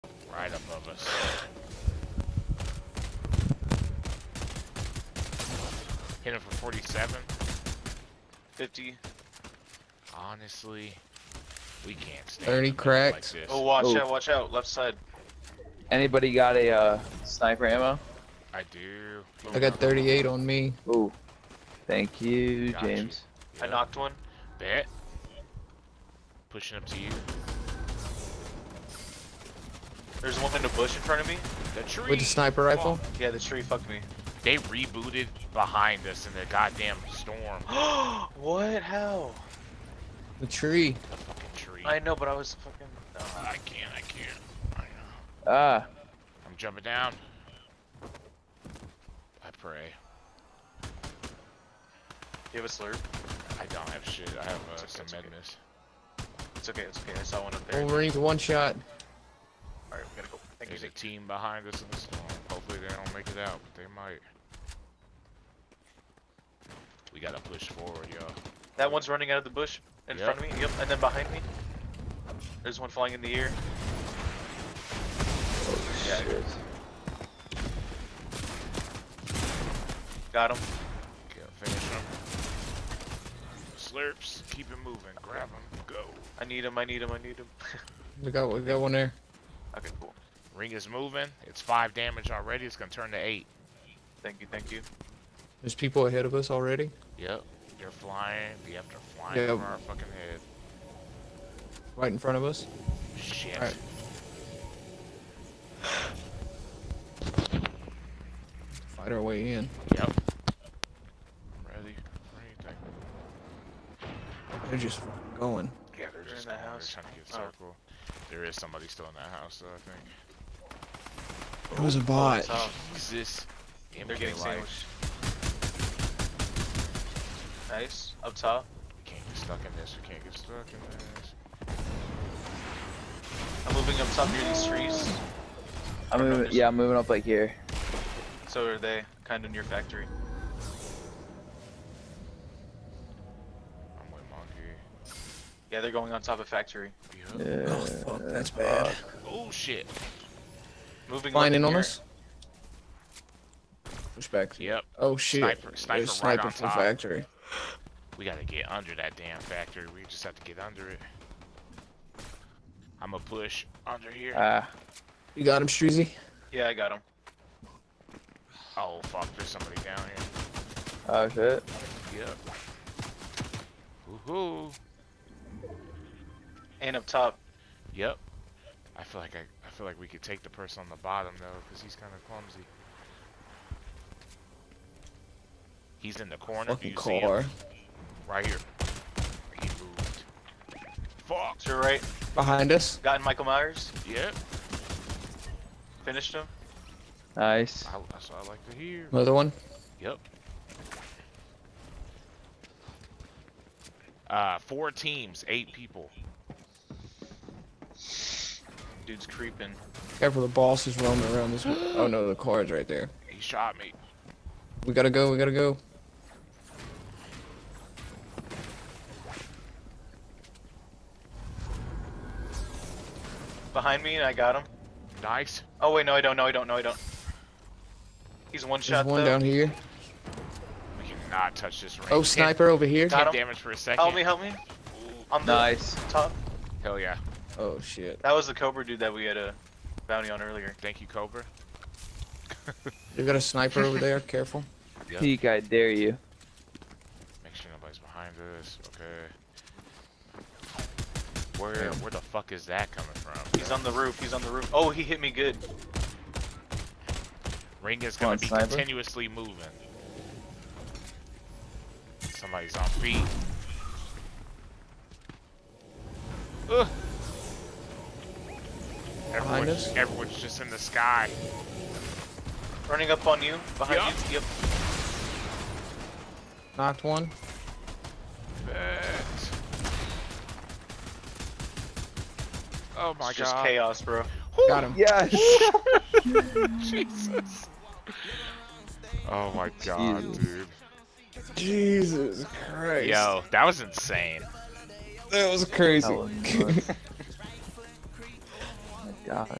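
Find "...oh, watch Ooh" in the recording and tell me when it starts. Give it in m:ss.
0:13.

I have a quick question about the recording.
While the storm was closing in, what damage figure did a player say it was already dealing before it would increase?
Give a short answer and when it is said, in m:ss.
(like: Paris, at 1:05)
5, at 1:31.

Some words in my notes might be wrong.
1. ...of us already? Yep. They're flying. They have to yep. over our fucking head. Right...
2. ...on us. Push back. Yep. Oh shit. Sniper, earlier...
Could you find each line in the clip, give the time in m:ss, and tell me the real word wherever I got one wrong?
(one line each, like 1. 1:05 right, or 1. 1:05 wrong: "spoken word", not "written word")
1. 1:36 right
2. 2:31 wrong: "sniper", not "earlier".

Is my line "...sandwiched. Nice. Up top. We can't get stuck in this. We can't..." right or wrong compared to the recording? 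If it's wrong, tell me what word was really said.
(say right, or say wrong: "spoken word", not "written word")
right.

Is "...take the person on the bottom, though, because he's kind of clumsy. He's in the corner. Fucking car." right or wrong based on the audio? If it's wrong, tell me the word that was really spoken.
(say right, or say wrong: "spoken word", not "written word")
right.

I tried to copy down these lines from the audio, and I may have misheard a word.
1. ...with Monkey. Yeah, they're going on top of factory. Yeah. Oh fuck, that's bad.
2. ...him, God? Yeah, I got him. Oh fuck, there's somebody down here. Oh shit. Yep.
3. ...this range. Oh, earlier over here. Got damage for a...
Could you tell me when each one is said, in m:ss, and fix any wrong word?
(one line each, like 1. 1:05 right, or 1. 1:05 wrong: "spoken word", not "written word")
1. 2:24 right
2. 2:45 wrong: "Streezy", not "God"
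3. 3:51 wrong: "sniper", not "earlier".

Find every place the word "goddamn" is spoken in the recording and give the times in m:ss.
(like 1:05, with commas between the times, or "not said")
0:36.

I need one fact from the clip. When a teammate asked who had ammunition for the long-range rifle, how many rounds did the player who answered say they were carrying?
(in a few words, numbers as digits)
38.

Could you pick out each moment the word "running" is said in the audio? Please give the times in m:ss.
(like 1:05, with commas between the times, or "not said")
1:09, 4:32.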